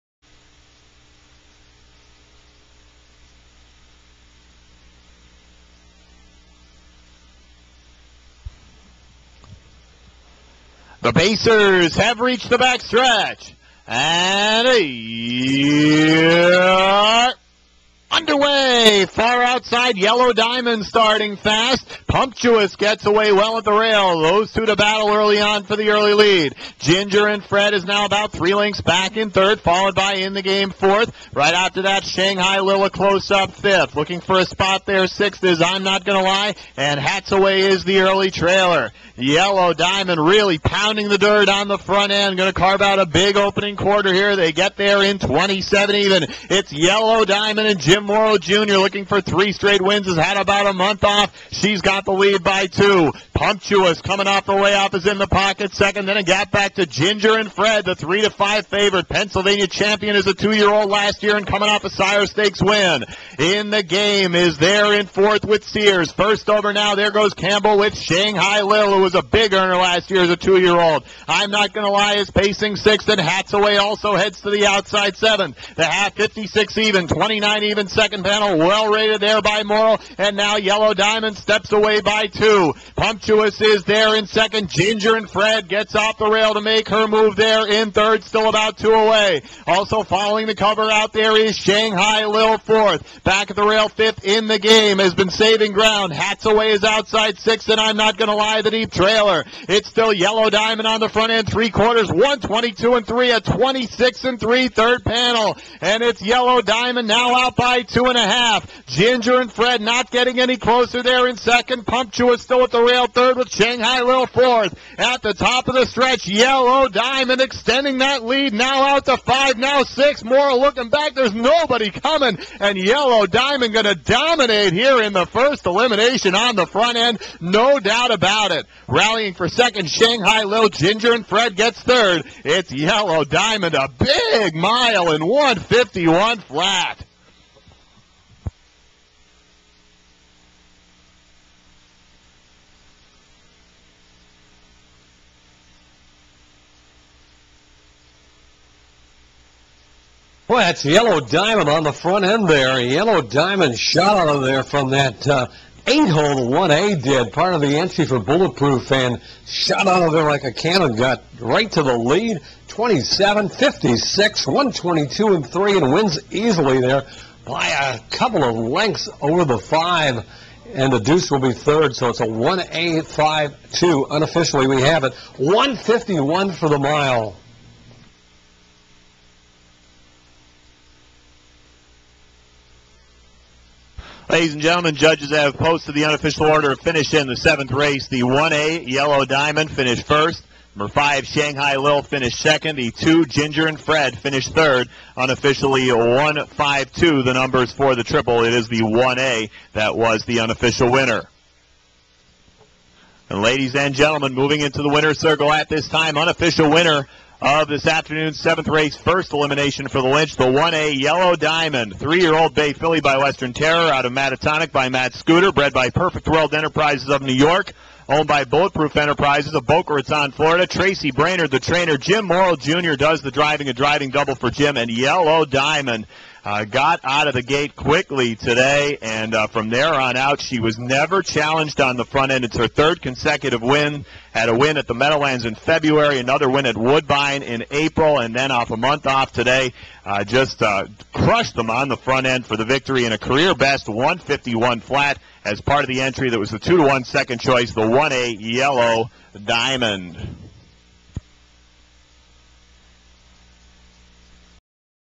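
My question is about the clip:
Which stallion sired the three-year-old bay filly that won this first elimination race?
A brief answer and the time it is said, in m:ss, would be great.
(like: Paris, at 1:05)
Western Terror, at 3:33.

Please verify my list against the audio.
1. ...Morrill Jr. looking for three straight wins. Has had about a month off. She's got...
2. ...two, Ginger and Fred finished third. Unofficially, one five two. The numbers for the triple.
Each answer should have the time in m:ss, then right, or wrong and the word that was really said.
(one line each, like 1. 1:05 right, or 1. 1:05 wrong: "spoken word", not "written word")
1. 0:48 right
2. 3:12 right.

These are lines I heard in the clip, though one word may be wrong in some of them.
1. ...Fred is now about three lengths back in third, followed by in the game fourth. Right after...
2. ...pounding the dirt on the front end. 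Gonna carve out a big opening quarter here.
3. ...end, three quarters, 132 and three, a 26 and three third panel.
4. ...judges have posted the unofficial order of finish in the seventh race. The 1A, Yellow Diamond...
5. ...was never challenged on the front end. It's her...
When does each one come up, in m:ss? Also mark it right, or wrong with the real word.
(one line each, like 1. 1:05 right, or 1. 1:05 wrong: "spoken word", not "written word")
1. 0:27 right
2. 0:40 right
3. 1:41 wrong: "122", not "132"
4. 3:04 right
5. 3:50 right.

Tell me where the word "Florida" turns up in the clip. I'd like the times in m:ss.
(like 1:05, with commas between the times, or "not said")
3:40.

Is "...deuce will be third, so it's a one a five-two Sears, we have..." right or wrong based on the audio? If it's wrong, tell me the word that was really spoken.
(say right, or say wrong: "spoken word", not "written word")
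wrong: "Unofficially", not "Sears".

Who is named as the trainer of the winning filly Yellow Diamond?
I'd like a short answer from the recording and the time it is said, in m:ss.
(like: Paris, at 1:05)
Tracy Brainerd, at 3:40.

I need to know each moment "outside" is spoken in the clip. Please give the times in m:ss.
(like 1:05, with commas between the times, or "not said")
0:19, 1:14, 1:36.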